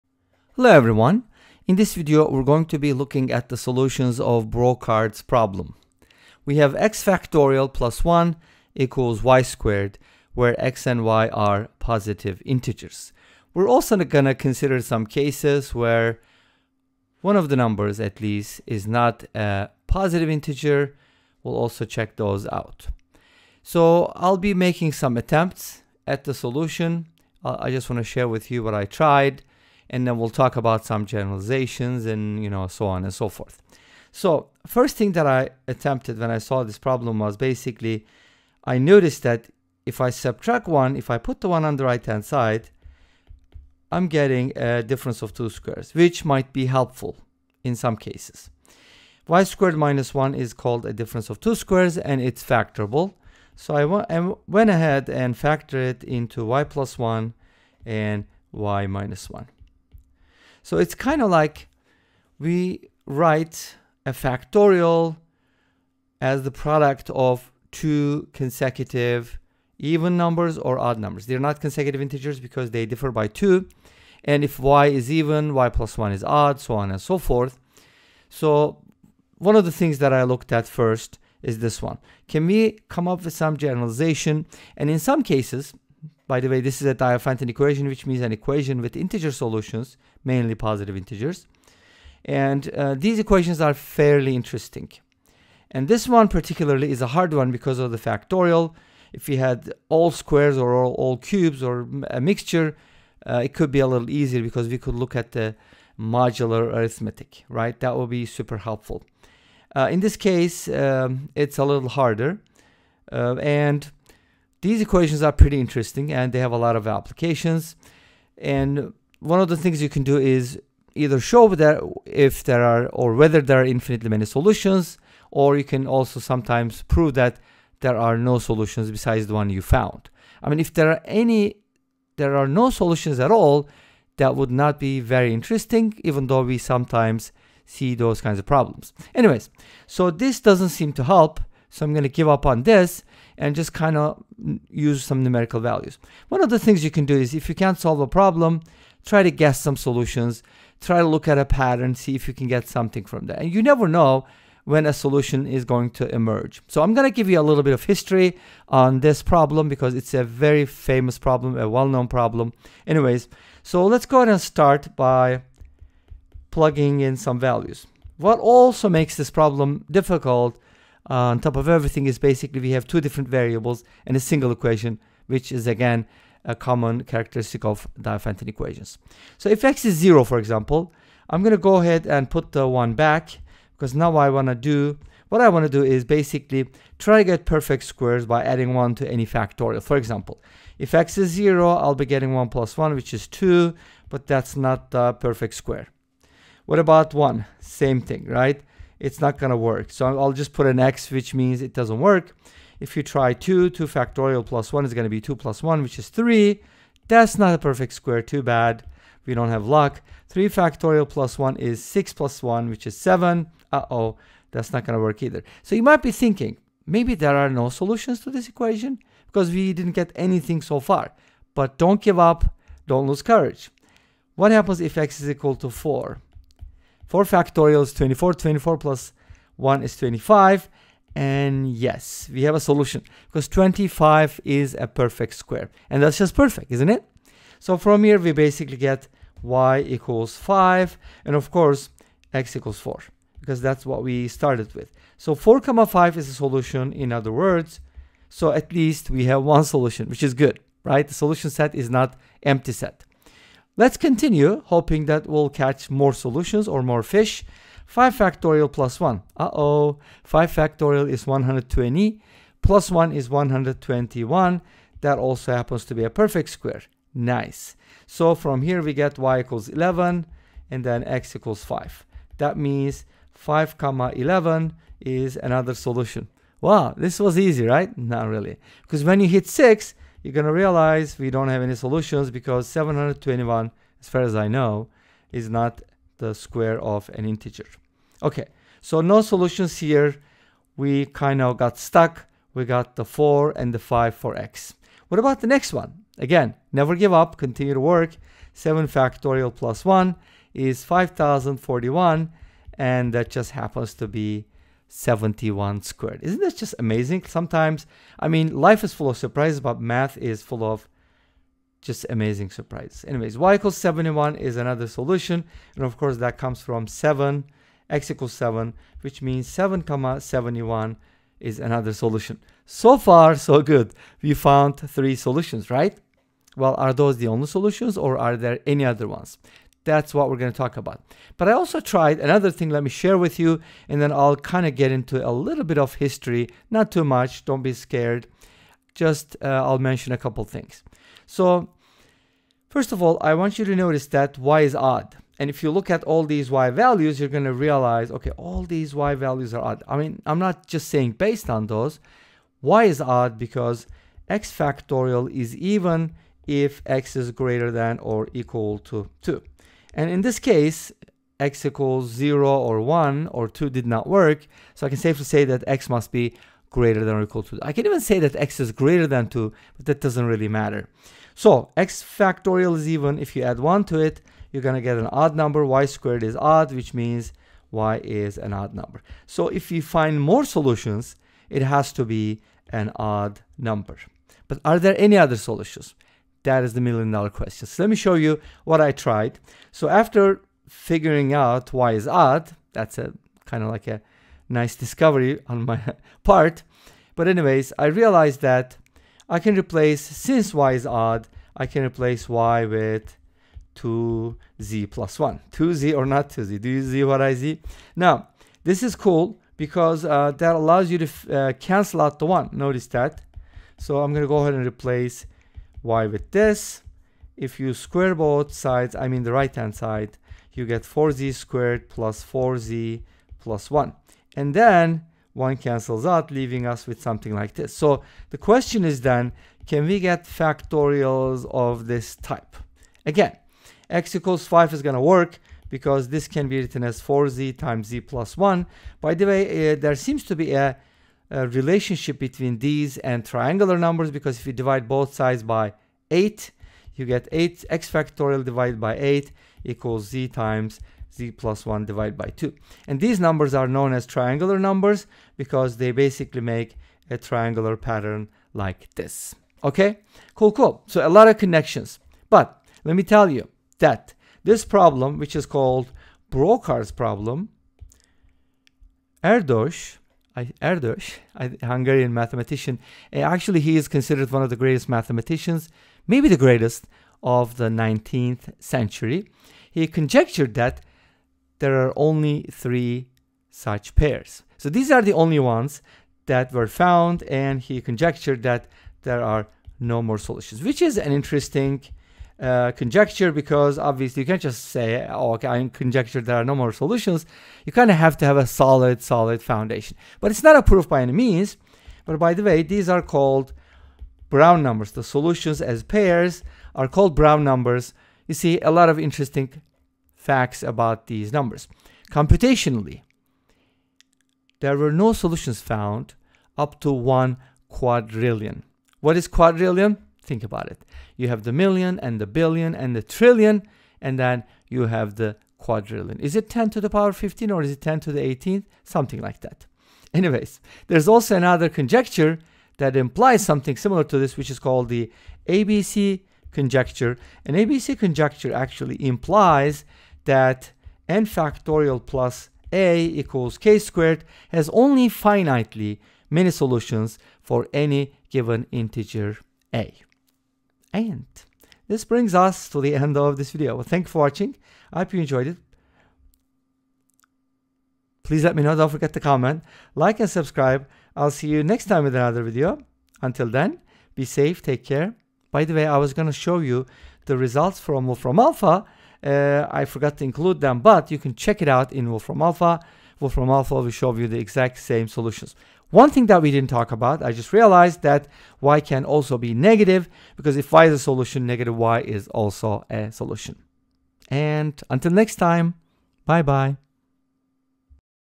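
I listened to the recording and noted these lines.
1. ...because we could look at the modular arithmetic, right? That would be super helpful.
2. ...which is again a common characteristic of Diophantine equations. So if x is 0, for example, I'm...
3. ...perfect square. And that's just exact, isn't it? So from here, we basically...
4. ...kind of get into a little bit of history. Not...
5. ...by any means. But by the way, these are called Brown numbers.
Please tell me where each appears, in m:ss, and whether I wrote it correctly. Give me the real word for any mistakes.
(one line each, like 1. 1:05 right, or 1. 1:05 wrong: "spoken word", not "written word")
1. 1:44 right
2. 2:55 right
3. 3:54 wrong: "perfect", not "exact"
4. 5:34 right
5. 8:20 right.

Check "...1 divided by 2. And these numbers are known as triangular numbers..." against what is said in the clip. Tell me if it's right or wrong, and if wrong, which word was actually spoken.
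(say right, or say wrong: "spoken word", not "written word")
right.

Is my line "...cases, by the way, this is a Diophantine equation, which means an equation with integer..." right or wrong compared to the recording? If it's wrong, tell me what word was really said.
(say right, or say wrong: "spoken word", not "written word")
right.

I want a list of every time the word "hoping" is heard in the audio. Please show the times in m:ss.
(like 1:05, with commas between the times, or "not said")
4:14.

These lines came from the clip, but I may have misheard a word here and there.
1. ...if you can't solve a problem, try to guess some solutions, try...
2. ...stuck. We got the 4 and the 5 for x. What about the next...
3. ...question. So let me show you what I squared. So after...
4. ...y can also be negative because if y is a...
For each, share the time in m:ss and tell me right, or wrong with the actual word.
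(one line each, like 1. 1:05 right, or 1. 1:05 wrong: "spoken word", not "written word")
1. 2:27 right
2. 4:51 right
3. 6:27 wrong: "tried", not "squared"
4. 9:38 right.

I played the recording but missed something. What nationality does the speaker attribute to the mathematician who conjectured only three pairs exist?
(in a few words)
Hungarian.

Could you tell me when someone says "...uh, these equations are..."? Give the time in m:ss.
1:32.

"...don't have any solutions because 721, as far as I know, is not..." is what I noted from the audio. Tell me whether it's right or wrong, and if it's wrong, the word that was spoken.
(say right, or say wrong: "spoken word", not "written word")
right.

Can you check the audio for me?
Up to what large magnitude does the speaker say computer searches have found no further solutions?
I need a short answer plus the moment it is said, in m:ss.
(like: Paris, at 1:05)
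One quadrillion, at 8:36.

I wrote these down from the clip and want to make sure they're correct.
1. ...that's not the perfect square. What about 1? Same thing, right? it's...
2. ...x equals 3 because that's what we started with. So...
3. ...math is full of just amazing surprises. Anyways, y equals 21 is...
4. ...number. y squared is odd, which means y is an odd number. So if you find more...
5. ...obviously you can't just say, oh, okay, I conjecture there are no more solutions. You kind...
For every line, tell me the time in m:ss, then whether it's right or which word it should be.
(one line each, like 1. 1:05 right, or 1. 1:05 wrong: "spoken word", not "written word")
1. 3:14 right
2. 4:02 wrong: "4", not "3"
3. 5:09 wrong: "71", not "21"
4. 6:15 right
5. 8:13 right.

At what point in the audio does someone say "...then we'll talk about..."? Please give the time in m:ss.
0:30.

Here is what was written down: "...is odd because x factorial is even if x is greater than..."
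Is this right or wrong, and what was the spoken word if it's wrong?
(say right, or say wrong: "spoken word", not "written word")
right.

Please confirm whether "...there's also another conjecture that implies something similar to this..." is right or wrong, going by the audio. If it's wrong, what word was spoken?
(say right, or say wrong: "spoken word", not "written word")
right.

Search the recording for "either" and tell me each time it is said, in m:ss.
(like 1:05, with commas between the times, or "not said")
2:00, 3:35.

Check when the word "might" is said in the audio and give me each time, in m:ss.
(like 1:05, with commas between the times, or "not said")
0:46, 3:35.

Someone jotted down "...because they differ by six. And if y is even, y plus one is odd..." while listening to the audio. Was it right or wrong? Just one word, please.
wrong.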